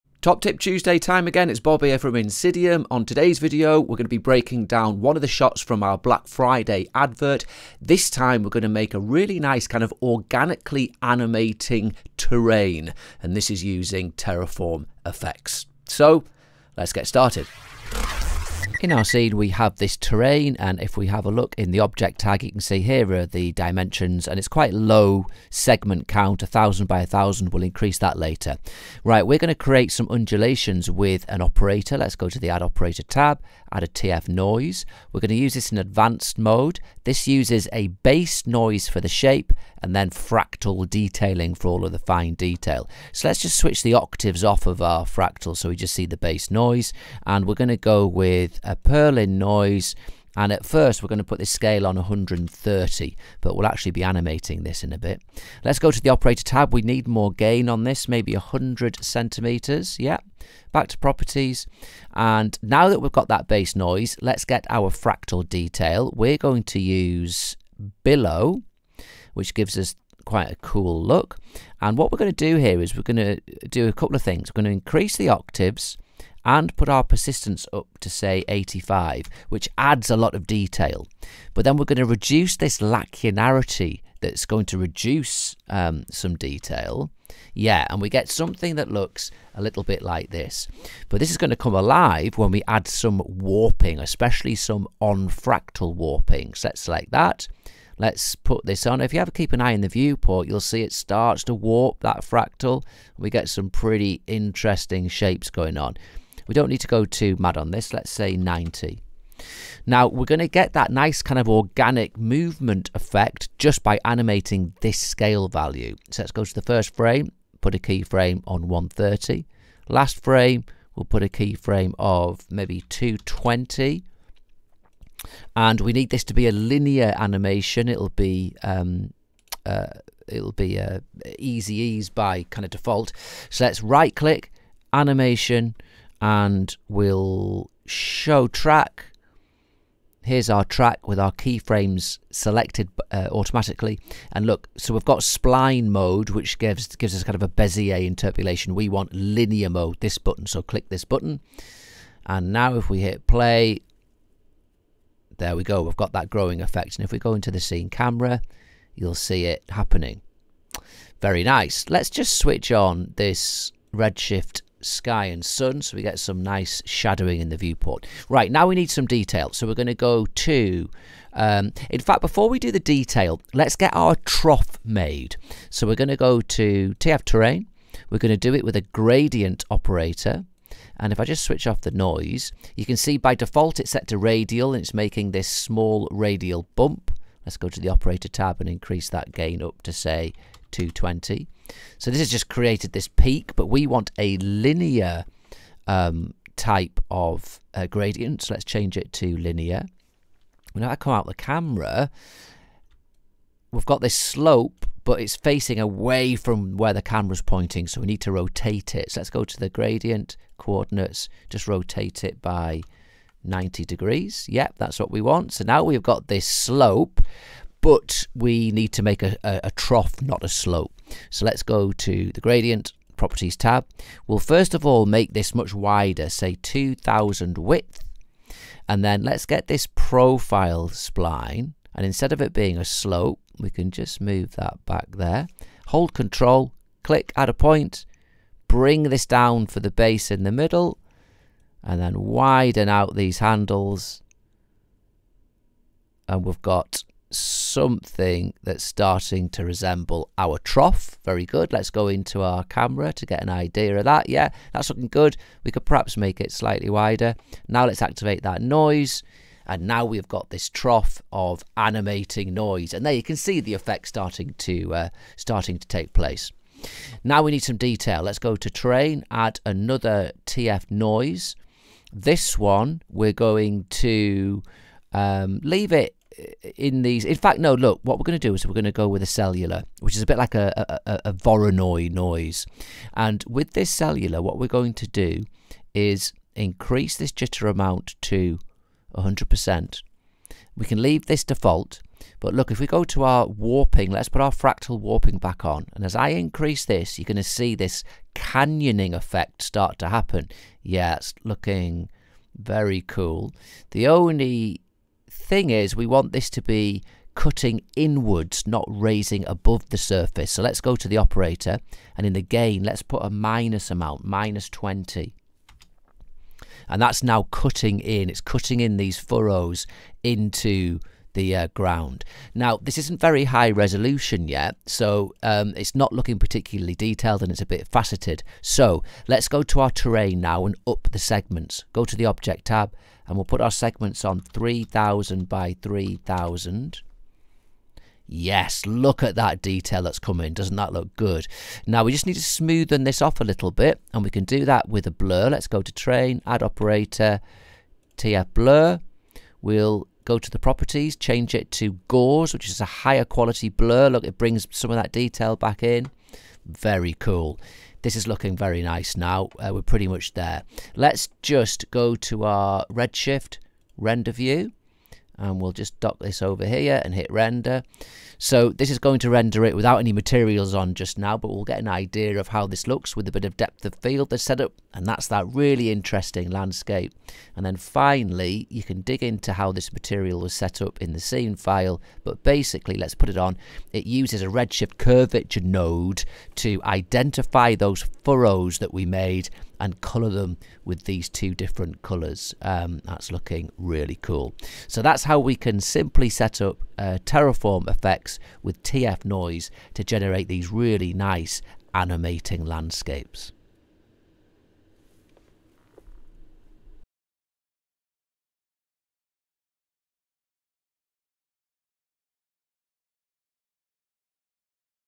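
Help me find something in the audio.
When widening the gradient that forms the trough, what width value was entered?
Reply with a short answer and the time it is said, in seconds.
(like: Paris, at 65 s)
2000, at 226 s.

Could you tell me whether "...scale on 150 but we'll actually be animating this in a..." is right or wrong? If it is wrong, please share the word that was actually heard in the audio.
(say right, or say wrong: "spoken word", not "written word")
wrong: "130", not "150".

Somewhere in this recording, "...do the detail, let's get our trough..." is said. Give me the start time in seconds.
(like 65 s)
172 s.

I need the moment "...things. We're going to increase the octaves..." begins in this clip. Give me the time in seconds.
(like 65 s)
74 s.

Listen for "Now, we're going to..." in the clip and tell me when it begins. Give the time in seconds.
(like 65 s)
109 s.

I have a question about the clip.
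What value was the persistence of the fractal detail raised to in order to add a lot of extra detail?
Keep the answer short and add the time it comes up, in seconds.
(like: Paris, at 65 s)
85, at 78 s.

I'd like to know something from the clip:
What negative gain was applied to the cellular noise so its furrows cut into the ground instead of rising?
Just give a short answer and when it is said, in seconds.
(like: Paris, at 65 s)
-20, at 314 s.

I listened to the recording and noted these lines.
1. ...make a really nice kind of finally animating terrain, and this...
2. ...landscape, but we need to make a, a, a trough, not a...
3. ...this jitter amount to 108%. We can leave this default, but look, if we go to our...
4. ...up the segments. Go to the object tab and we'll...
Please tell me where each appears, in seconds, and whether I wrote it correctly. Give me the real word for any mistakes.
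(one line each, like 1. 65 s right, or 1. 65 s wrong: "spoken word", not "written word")
1. 8 s wrong: "organically", not "finally"
2. 216 s wrong: "slope", not "landscape"
3. 287 s wrong: "100", not "108"
4. 330 s right.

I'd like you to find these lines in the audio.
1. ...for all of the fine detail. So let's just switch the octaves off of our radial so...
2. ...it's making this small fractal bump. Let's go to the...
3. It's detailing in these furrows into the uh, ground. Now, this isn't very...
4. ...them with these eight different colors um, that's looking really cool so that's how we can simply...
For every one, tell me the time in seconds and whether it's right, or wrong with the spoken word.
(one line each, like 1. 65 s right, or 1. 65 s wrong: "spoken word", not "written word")
1. 41 s wrong: "fractal", not "radial"
2. 184 s wrong: "radial", not "fractal"
3. 318 s wrong: "cutting", not "detailing"
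4. 390 s wrong: "two", not "eight".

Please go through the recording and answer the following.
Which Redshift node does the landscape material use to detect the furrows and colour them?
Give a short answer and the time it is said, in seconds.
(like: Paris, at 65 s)
curvature node, at 384 s.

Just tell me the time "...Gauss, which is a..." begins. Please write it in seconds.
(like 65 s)
352 s.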